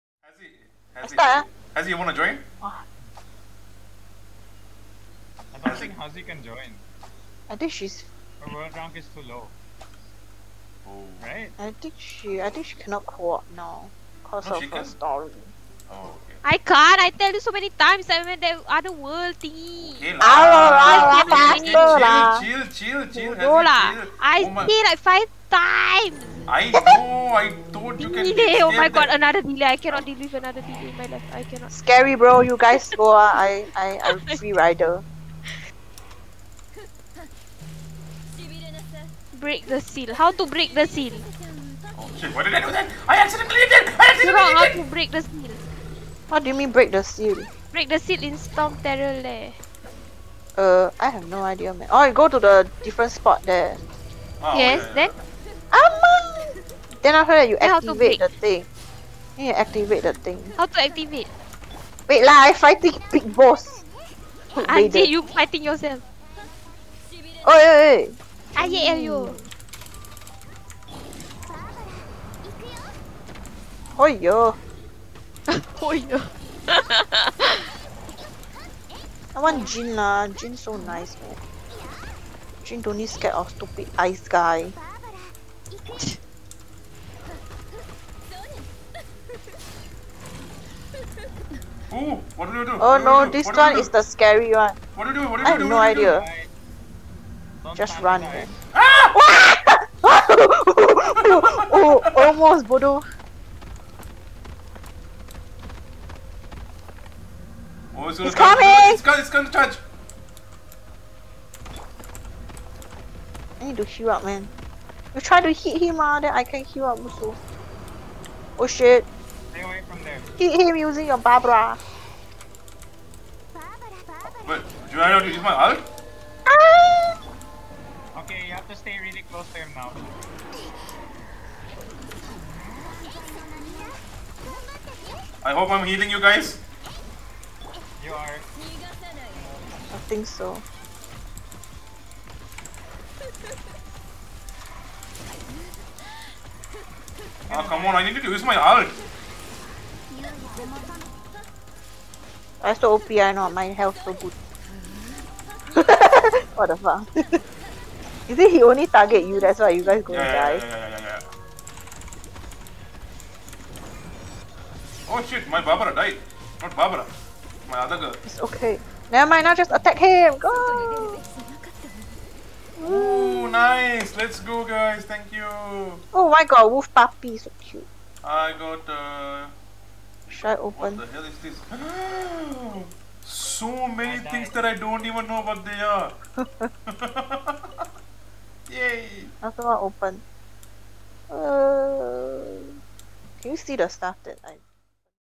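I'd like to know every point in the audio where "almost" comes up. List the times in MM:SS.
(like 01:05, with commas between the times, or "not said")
01:42.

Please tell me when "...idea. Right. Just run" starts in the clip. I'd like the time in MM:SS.
01:35.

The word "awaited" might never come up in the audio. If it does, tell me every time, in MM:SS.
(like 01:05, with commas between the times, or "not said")
not said.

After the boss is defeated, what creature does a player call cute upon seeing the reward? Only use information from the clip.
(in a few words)
wolf puppy.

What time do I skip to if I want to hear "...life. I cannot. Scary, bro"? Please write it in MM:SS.
00:31.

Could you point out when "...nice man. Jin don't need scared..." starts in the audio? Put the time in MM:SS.
01:20.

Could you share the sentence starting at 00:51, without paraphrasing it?
Oh, you go to the different spot there.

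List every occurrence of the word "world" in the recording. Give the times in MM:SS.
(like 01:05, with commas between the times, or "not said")
00:08, 00:18.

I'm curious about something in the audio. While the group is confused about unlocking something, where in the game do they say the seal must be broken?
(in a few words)
Storm Terror Lair.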